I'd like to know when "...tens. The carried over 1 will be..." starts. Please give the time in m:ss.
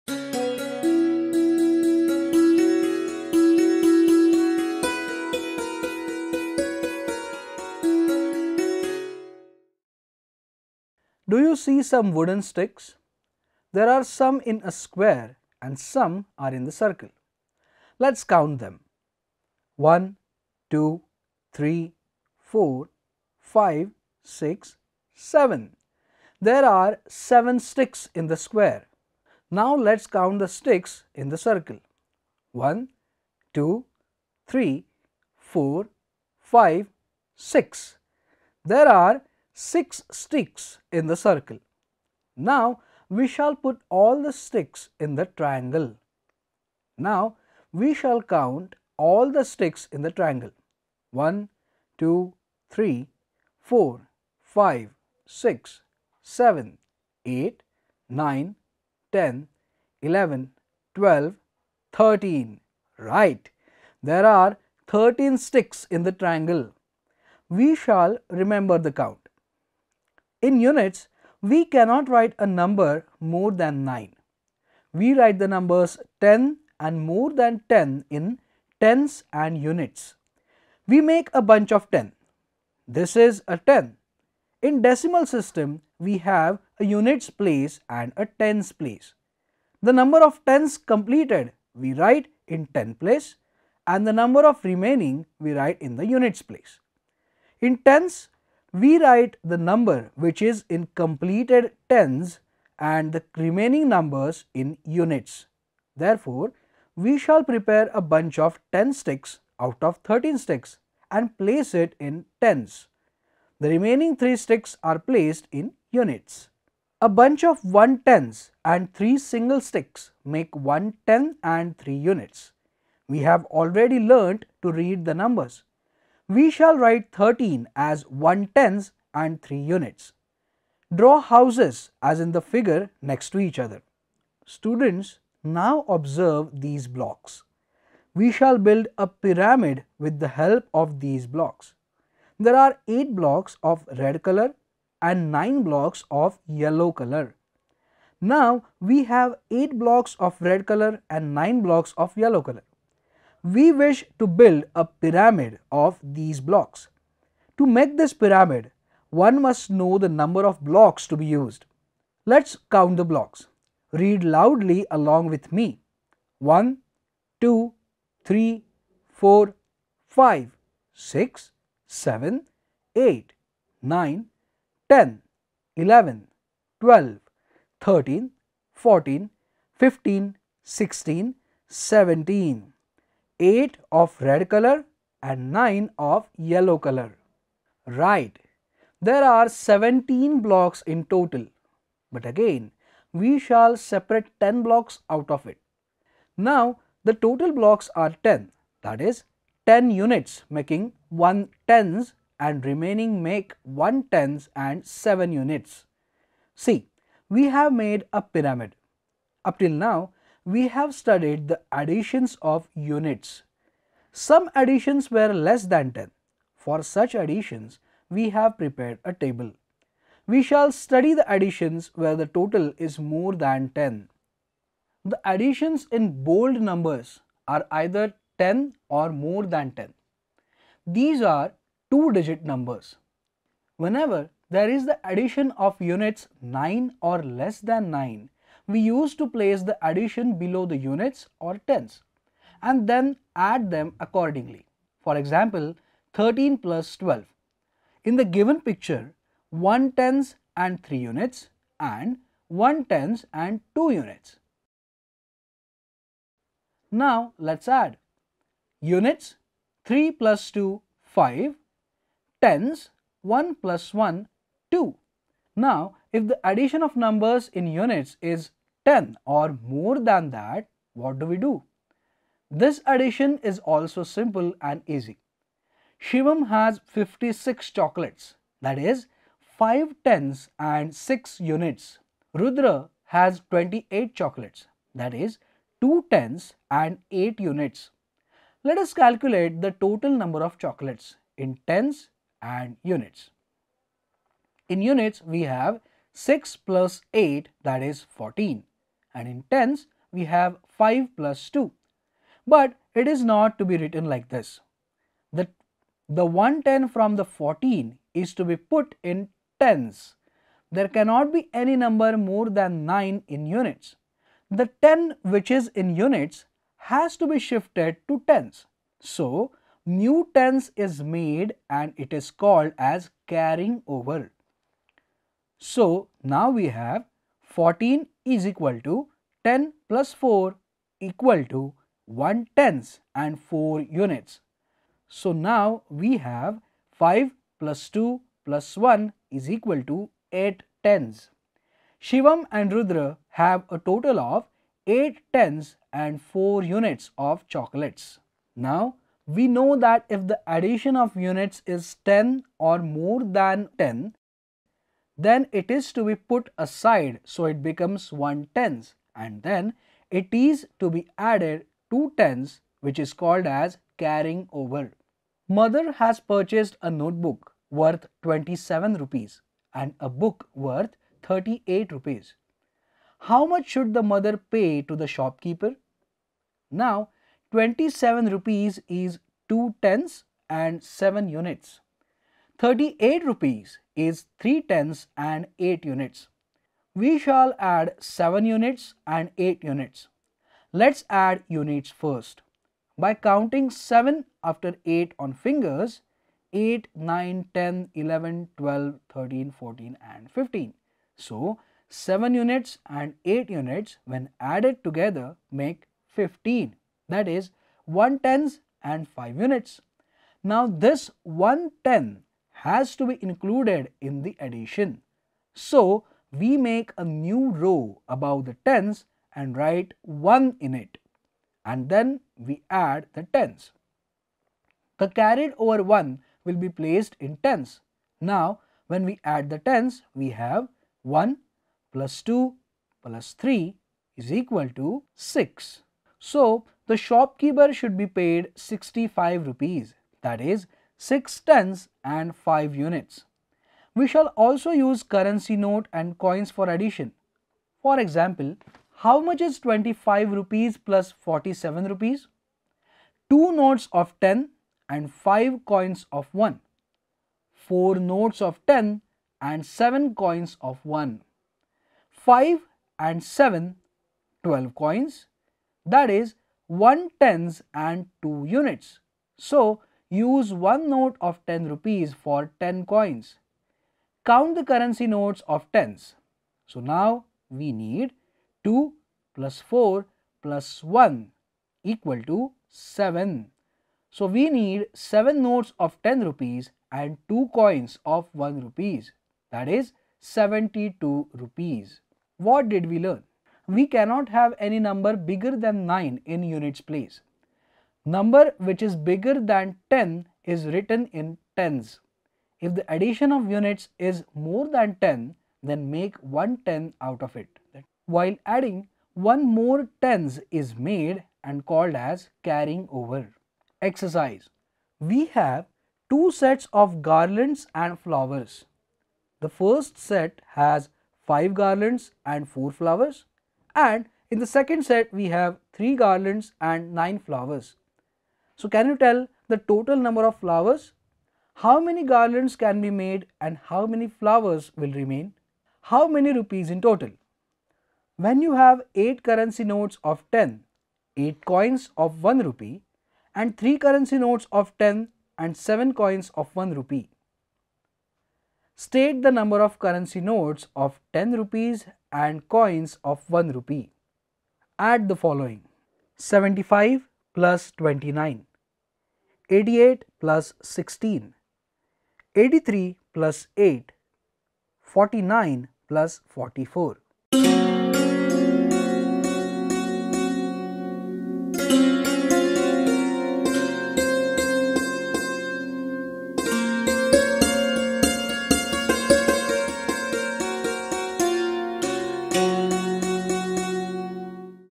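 7:03.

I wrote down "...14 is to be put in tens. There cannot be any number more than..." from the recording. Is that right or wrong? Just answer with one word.
right.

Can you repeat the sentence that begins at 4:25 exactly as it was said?
Now if the addition of numbers in units is 10 or more than that, what do we do?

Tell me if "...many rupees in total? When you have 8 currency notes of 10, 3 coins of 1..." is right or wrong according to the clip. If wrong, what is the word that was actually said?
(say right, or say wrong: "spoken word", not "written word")
wrong: "8", not "3".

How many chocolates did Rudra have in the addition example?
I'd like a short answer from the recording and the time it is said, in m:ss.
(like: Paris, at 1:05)
28, at 4:42.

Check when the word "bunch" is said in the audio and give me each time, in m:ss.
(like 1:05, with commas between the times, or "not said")
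1:21, 1:48, 1:57.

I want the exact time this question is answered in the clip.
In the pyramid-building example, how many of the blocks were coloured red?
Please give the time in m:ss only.
2:22.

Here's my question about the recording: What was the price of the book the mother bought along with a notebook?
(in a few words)
38 rupees.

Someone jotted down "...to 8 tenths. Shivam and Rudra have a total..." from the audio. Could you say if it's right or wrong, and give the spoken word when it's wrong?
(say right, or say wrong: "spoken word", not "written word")
right.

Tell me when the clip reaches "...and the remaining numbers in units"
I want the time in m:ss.
1:42.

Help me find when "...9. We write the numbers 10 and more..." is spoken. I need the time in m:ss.
1:13.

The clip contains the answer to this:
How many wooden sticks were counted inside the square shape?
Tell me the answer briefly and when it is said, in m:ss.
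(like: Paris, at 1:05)
7, at 0:26.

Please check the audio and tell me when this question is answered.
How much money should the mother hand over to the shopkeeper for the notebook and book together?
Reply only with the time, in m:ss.
7:17.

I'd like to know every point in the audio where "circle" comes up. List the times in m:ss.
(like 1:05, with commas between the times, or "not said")
0:16, 0:31, 0:41.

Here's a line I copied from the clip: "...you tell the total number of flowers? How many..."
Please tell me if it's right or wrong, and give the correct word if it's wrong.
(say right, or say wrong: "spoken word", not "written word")
right.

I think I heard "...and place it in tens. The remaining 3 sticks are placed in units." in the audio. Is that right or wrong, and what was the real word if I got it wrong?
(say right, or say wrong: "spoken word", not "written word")
right.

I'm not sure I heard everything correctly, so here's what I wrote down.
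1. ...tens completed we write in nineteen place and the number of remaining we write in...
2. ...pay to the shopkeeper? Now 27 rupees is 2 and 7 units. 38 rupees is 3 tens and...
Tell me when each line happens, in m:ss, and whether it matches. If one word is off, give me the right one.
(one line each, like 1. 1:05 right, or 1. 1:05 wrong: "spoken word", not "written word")
1. 1:30 wrong: "ten", not "nineteen"
2. 6:14 right.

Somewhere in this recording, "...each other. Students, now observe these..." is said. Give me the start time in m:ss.
2:13.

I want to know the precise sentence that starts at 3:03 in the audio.
8 of red color and 9 of yellow color.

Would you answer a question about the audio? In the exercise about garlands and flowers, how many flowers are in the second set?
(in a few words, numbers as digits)
9.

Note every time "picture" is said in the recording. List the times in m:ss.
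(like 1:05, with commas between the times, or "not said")
4:08.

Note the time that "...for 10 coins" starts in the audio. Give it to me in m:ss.
7:52.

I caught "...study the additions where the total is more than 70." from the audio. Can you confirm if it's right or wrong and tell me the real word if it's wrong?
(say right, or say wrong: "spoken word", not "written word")
wrong: "10", not "70".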